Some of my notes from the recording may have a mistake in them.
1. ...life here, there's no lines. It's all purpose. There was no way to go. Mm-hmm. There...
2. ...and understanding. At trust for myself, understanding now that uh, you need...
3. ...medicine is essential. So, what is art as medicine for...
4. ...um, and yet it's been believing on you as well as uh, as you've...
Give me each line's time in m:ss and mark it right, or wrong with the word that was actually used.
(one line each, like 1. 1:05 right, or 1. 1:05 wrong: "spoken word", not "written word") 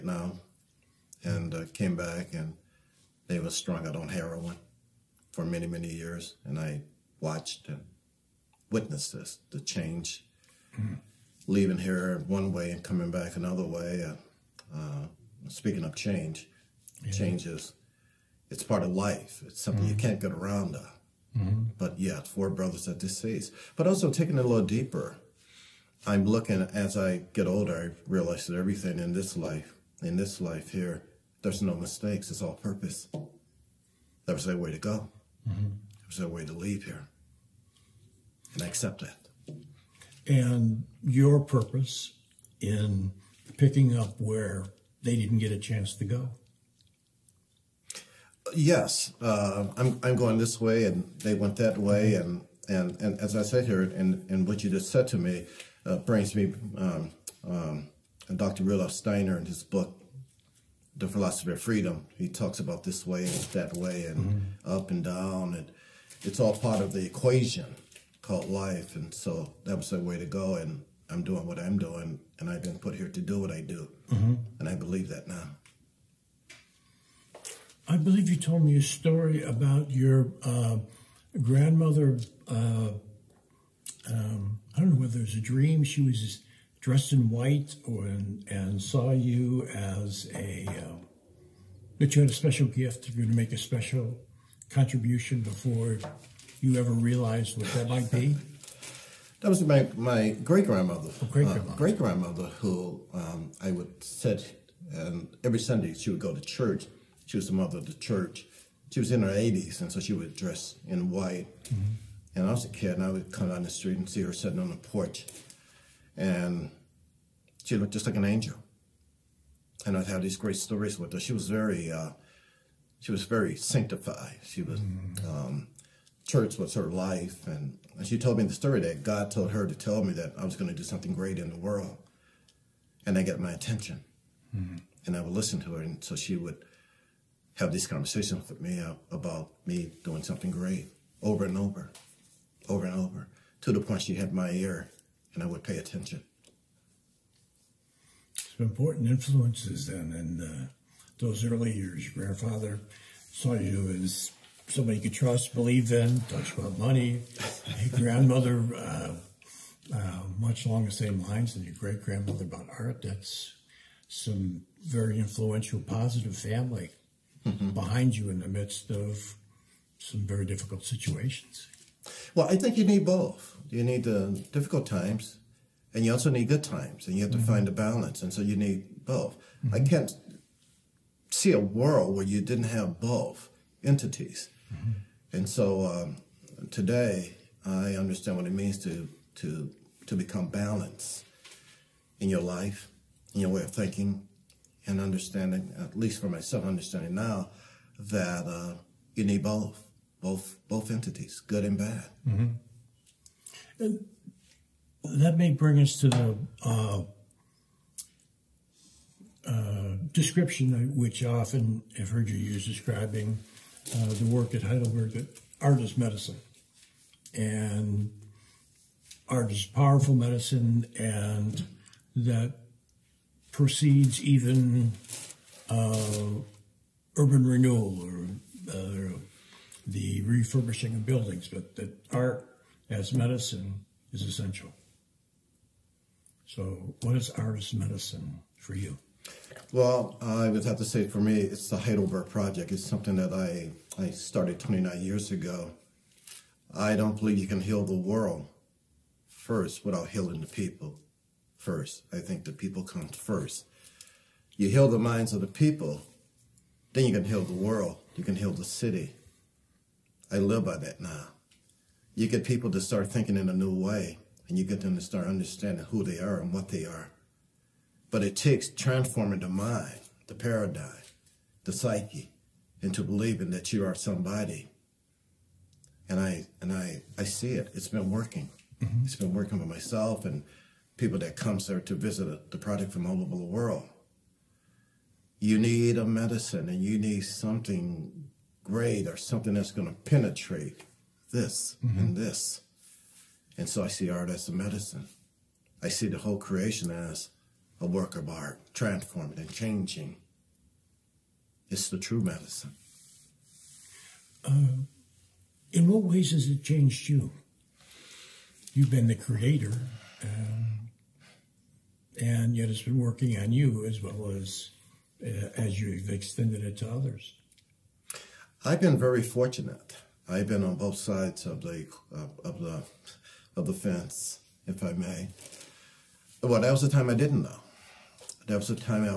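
1. 0:30 wrong: "mistakes", not "lines"
2. 3:14 wrong: "least", not "trust"
3. 3:53 right
4. 5:10 wrong: "working", not "believing".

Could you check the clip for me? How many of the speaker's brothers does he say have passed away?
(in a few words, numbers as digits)
4.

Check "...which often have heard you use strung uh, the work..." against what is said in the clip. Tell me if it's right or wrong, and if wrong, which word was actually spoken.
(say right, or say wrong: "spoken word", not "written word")
wrong: "describing", not "strung".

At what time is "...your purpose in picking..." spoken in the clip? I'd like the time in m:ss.
0:41.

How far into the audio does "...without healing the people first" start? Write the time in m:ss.
4:09.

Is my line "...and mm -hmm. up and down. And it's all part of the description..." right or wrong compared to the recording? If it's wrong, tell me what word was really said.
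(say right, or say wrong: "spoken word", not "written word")
wrong: "equation", not "description".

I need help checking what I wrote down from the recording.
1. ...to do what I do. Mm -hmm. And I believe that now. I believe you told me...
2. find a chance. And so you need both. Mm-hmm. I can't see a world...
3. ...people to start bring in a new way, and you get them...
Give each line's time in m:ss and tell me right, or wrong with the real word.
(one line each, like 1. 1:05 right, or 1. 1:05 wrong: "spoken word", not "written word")
1. 1:13 right
2. 2:57 wrong: "balance", not "chance"
3. 4:22 wrong: "thinking", not "bring".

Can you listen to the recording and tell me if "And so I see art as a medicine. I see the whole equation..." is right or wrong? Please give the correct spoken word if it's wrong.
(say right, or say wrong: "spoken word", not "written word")
wrong: "creation", not "equation".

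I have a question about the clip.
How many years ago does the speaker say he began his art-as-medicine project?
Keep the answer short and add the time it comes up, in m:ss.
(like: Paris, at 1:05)
29, at 4:04.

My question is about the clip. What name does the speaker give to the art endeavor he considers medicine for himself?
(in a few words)
Heidelberg Project.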